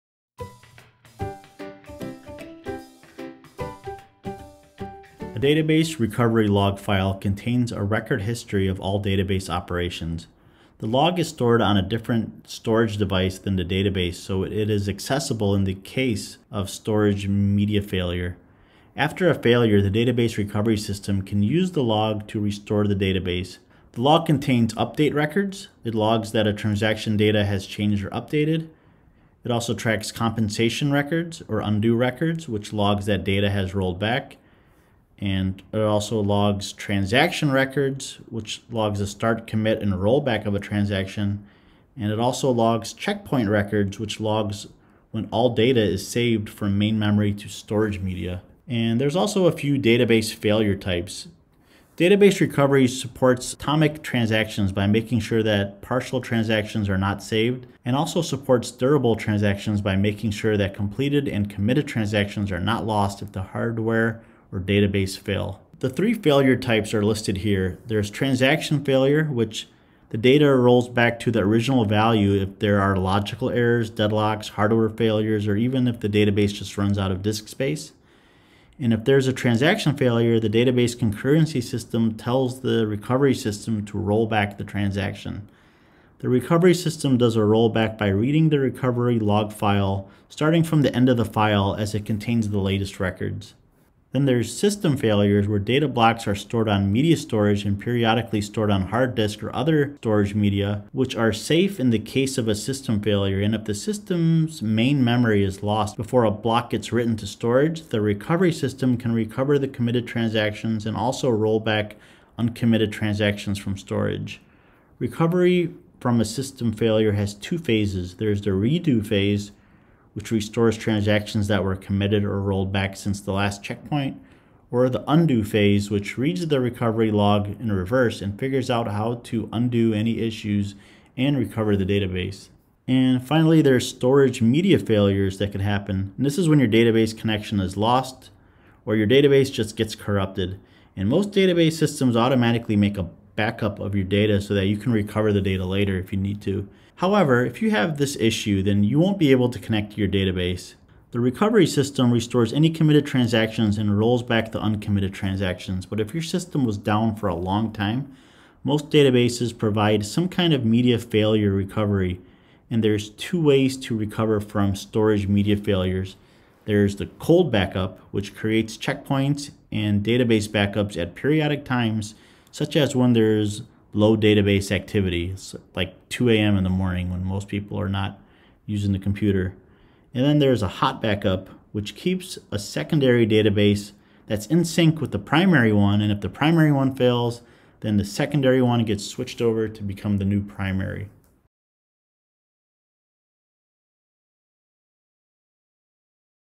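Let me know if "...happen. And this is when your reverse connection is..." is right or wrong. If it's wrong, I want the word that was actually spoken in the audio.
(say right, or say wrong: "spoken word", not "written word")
wrong: "database", not "reverse".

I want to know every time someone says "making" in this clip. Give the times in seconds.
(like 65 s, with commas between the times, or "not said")
54 s, 59 s.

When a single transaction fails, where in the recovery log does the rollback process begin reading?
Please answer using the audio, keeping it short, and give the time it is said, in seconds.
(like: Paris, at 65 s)
The end of the file, at 90 s.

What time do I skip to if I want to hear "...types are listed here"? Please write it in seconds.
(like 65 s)
66 s.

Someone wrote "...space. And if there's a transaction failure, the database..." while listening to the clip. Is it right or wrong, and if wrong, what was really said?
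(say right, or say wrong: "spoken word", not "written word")
right.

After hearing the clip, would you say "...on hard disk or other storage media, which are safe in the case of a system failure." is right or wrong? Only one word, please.
right.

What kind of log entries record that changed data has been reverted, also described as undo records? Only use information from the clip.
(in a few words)
Compensation records.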